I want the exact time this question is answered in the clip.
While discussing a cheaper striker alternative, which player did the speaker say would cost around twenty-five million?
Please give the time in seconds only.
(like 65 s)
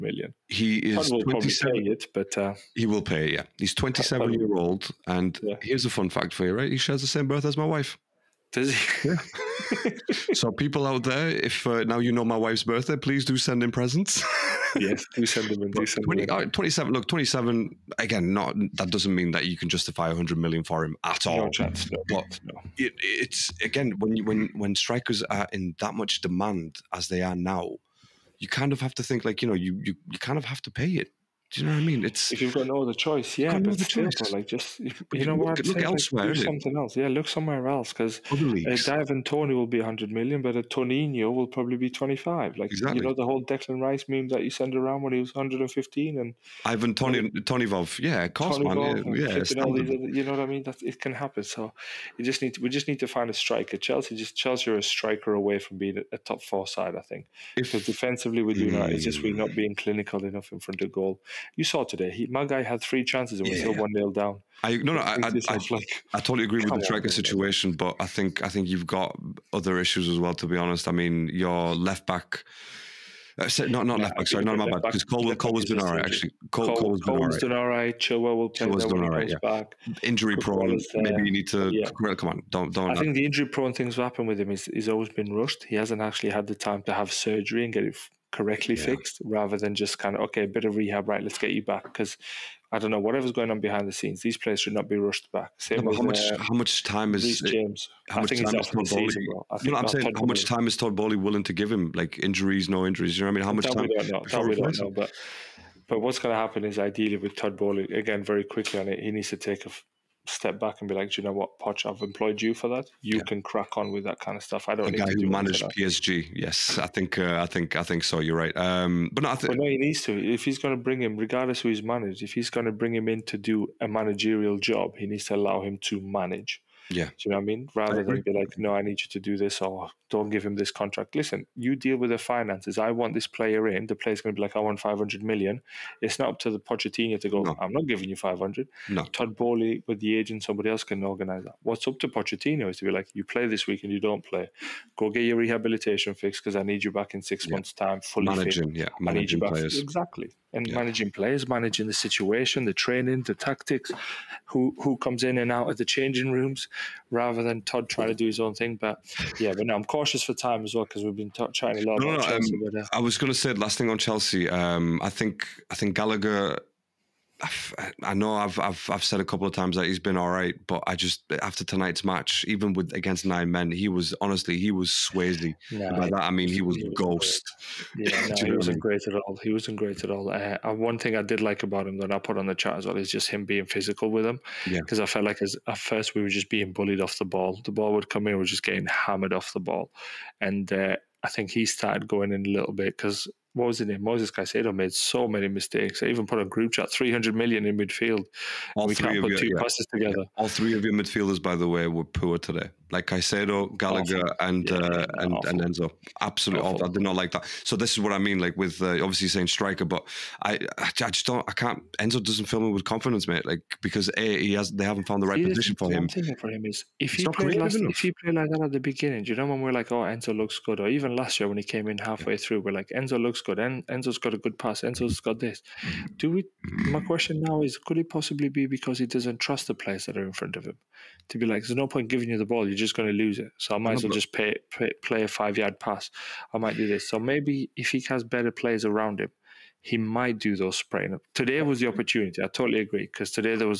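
40 s.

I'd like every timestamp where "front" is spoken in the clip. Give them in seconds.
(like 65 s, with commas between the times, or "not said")
60 s, 230 s.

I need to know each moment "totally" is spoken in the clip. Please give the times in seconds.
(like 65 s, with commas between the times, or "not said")
66 s, 242 s.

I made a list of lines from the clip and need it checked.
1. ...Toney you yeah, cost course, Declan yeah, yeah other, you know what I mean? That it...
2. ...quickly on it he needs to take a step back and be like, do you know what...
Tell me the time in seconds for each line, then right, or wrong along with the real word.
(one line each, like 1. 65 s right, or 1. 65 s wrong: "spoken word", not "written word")
1. 46 s wrong: "Tonivov", not "Declan"
2. 108 s right.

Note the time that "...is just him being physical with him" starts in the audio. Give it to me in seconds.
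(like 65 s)
182 s.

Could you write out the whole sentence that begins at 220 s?
Or even last year when he came in halfway yeah.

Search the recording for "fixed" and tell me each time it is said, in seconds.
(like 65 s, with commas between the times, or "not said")
88 s, 146 s.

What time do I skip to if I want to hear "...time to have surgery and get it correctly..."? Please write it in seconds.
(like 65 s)
86 s.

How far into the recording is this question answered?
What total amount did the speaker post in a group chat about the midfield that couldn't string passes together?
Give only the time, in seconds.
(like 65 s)
196 s.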